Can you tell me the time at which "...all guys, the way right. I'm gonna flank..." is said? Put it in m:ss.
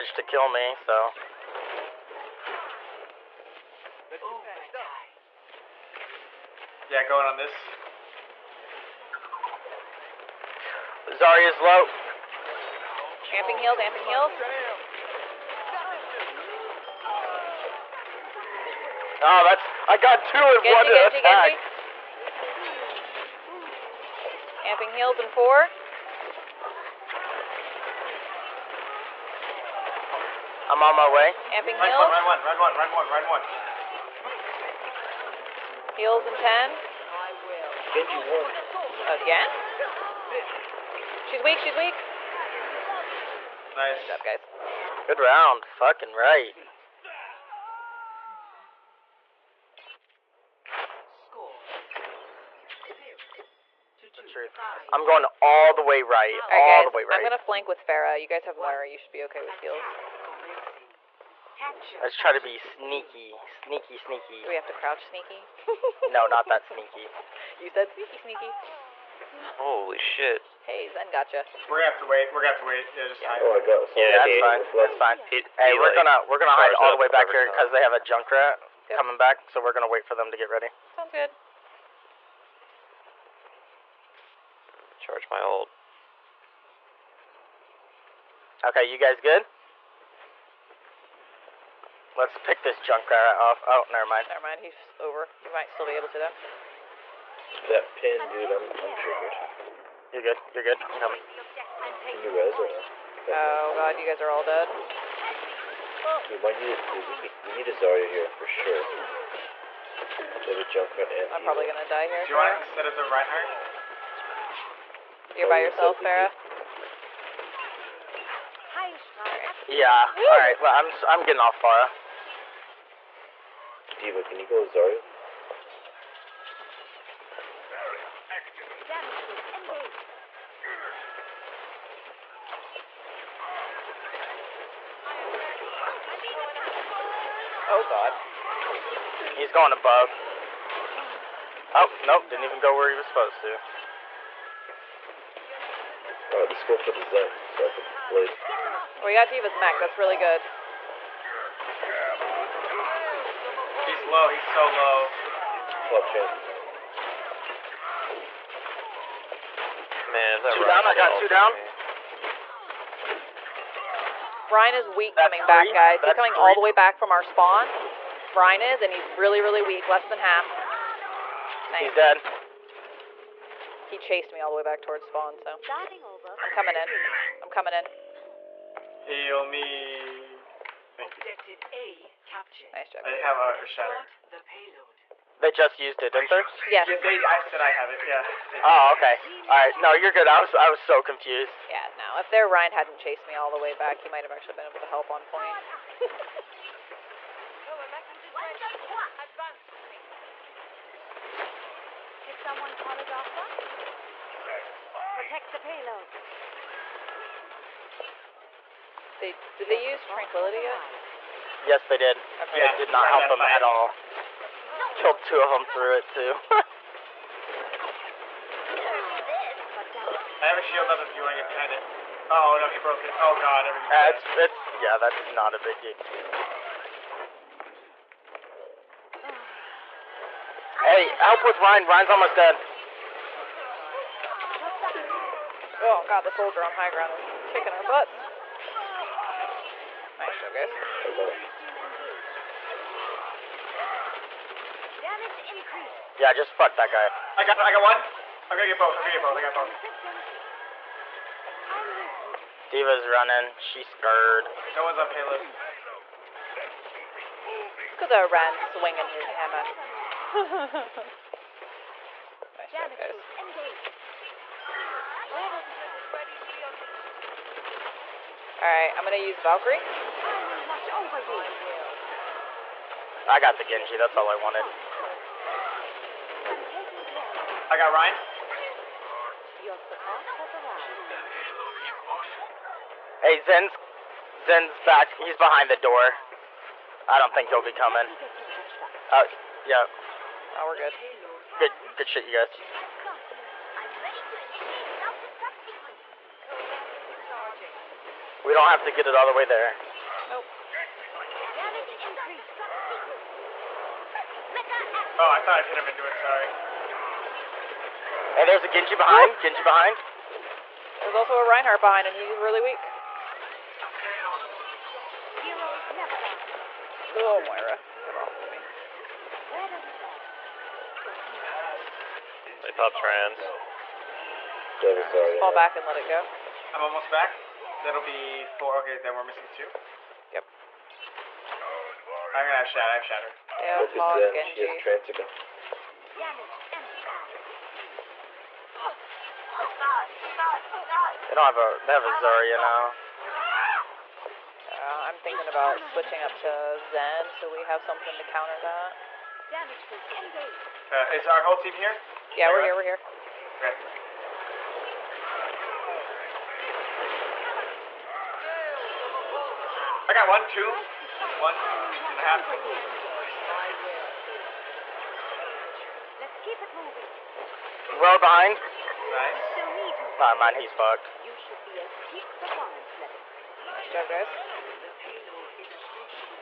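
0:56.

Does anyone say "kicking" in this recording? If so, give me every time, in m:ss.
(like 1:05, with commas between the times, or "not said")
3:57.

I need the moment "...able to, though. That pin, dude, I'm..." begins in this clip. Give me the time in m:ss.
1:35.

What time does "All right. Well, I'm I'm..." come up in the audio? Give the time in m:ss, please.
2:00.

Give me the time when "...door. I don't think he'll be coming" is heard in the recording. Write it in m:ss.
4:45.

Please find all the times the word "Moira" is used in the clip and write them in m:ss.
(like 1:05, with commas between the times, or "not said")
0:58, 5:17.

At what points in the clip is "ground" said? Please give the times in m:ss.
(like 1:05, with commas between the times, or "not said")
3:56.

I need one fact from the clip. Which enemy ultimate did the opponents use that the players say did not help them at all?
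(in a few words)
Tranquility.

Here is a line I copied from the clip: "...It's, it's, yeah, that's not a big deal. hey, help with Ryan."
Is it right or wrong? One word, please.
right.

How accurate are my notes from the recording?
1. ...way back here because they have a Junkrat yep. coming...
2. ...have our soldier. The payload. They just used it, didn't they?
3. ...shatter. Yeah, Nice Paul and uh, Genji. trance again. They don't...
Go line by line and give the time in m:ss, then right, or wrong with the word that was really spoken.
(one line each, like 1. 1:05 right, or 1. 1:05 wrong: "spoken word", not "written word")
1. 1:16 right
2. 3:03 wrong: "shatter", not "soldier"
3. 5:33 wrong: "Focus", not "Nice".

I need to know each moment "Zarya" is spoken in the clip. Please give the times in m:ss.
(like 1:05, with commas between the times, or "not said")
0:11, 1:47, 2:04, 5:42.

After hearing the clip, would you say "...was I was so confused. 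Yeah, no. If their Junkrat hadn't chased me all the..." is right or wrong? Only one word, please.
wrong.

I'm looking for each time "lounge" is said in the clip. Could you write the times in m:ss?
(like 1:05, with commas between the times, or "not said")
not said.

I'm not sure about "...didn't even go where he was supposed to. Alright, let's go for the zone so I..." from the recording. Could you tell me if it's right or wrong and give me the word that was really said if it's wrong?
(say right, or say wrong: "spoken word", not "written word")
right.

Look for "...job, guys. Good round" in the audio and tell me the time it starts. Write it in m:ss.
0:44.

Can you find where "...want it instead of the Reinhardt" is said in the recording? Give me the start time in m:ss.
1:52.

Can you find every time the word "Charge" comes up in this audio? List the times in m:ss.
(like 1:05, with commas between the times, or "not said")
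1:24.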